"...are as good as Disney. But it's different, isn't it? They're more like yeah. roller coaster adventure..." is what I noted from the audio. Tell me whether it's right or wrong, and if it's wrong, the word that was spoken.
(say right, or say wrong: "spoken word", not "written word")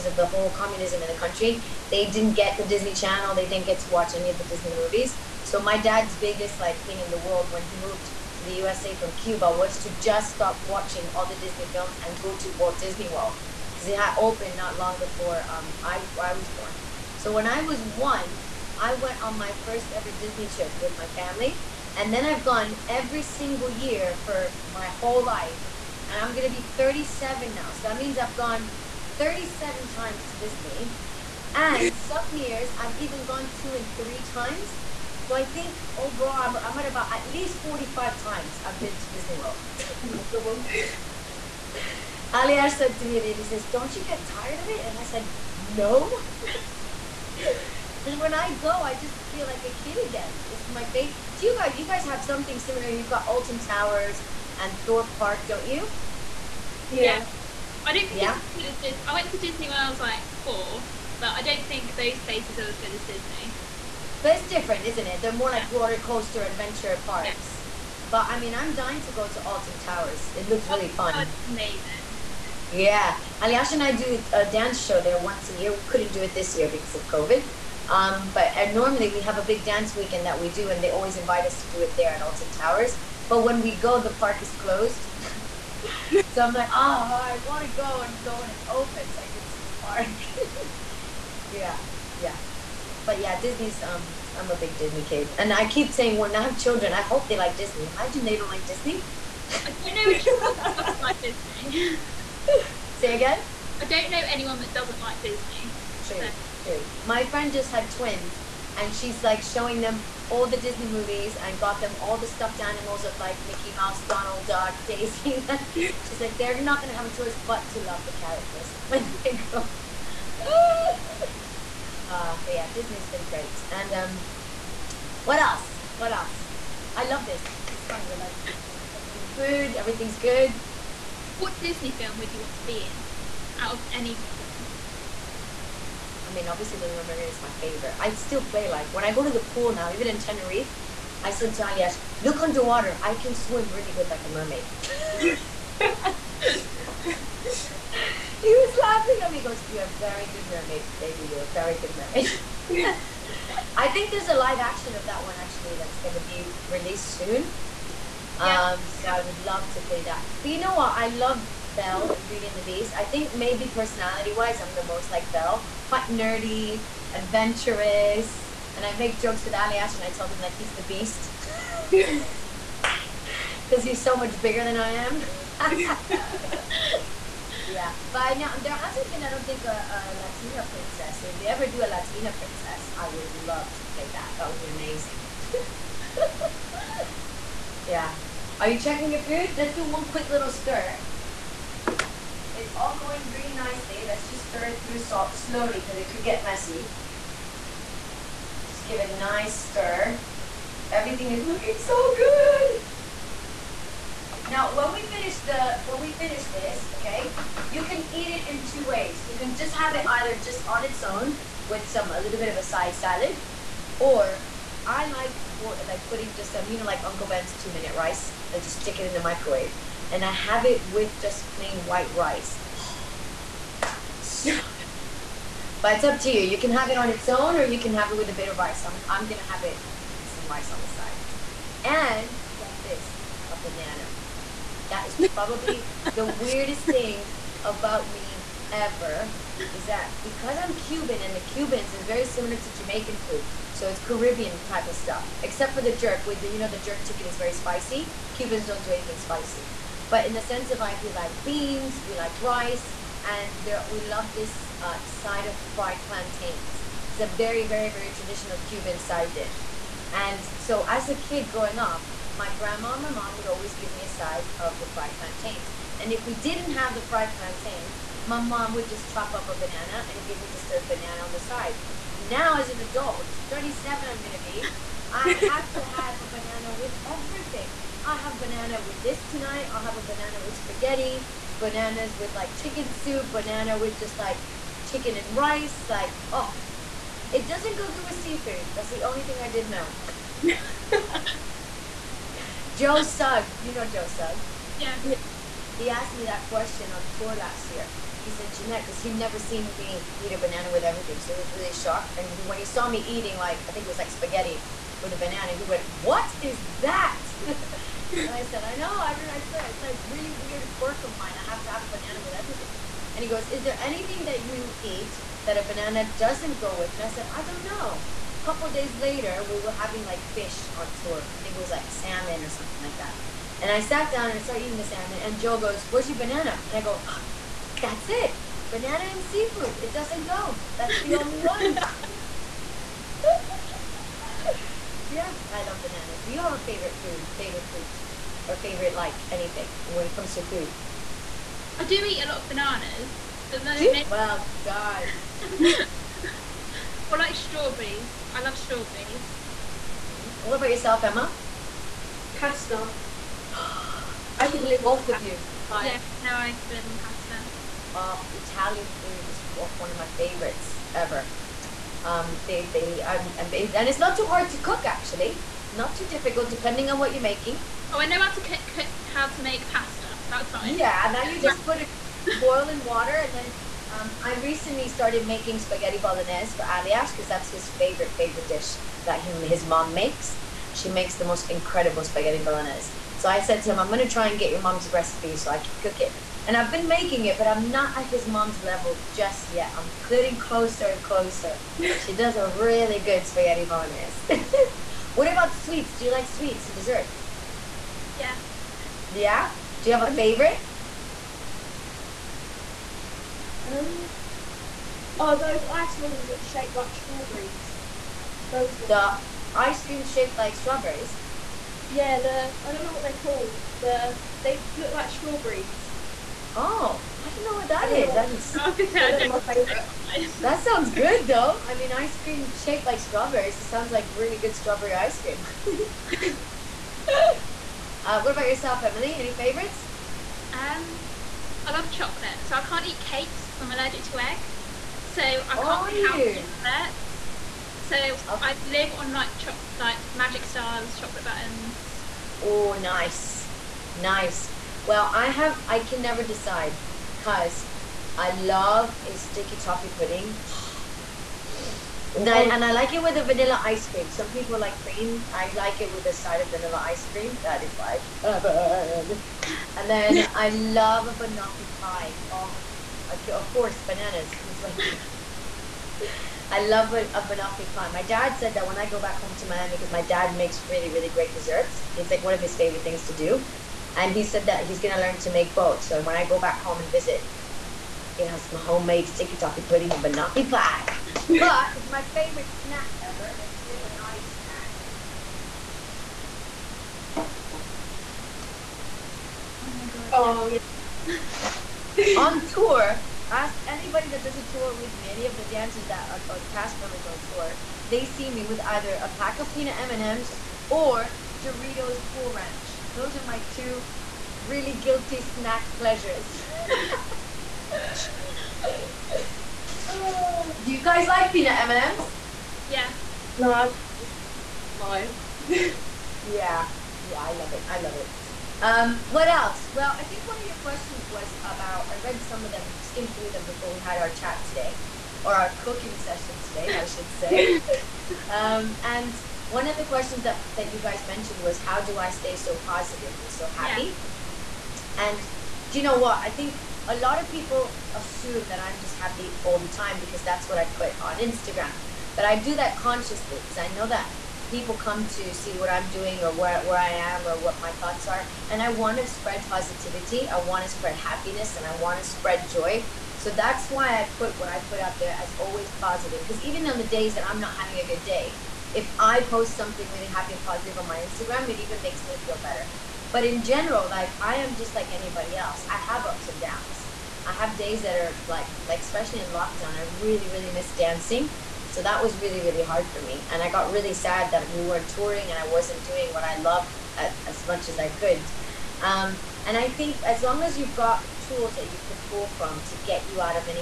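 right.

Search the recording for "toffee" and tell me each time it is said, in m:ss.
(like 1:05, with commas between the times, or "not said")
7:29, 7:59.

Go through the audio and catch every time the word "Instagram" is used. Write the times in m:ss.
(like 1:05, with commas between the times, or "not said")
9:01, 9:21.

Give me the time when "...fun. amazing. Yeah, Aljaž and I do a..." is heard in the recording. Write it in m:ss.
1:10.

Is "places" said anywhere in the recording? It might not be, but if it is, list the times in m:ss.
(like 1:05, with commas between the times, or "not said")
1:02.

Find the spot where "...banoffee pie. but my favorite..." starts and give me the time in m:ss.
8:00.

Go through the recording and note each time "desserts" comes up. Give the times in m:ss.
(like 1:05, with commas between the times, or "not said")
6:36, 7:16, 7:51.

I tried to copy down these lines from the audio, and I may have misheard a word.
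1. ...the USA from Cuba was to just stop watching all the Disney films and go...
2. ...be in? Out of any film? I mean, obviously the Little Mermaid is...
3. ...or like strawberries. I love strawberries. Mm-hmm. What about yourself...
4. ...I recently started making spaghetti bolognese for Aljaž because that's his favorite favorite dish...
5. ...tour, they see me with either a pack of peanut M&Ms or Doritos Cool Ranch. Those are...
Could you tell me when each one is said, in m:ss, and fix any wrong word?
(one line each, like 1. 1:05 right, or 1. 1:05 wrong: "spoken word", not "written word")
1. 0:08 right
2. 2:12 right
3. 5:47 right
4. 6:14 right
5. 8:17 right.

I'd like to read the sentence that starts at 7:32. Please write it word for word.
and I like it with a vanilla ice cream.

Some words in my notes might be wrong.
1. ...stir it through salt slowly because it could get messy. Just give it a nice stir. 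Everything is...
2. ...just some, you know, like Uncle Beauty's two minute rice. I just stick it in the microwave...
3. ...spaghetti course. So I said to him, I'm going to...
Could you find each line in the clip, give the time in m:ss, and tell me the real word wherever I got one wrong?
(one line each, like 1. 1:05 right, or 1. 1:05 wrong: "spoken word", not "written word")
1. 3:14 right
2. 3:36 wrong: "Ben", not "Beauty"
3. 6:22 wrong: "bolognese", not "course".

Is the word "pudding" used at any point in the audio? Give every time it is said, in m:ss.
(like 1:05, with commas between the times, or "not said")
7:29, 7:59.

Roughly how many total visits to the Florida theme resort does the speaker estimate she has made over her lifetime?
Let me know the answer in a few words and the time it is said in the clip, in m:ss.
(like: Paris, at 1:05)
45, at 0:37.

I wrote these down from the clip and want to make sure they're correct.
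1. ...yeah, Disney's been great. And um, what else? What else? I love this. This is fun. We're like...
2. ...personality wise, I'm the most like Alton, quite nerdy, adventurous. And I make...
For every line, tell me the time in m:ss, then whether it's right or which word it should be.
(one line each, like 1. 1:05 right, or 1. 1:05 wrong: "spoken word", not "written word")
1. 2:02 right
2. 2:43 wrong: "Belle", not "Alton".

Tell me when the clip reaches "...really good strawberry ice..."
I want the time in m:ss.
7:04.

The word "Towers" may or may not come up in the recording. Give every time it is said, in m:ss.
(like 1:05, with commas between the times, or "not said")
0:53, 1:09, 1:22.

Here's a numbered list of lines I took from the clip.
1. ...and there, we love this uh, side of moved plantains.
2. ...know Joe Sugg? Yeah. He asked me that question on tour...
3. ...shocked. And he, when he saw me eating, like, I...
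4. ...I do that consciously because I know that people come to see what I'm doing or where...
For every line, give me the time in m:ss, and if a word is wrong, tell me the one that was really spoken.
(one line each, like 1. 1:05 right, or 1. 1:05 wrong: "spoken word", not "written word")
1. 4:13 wrong: "fried", not "moved"
2. 4:53 right
3. 5:01 right
4. 9:02 right.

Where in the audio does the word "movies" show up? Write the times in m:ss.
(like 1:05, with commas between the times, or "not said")
0:04, 1:50.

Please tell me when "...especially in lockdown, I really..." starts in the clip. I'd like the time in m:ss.
9:28.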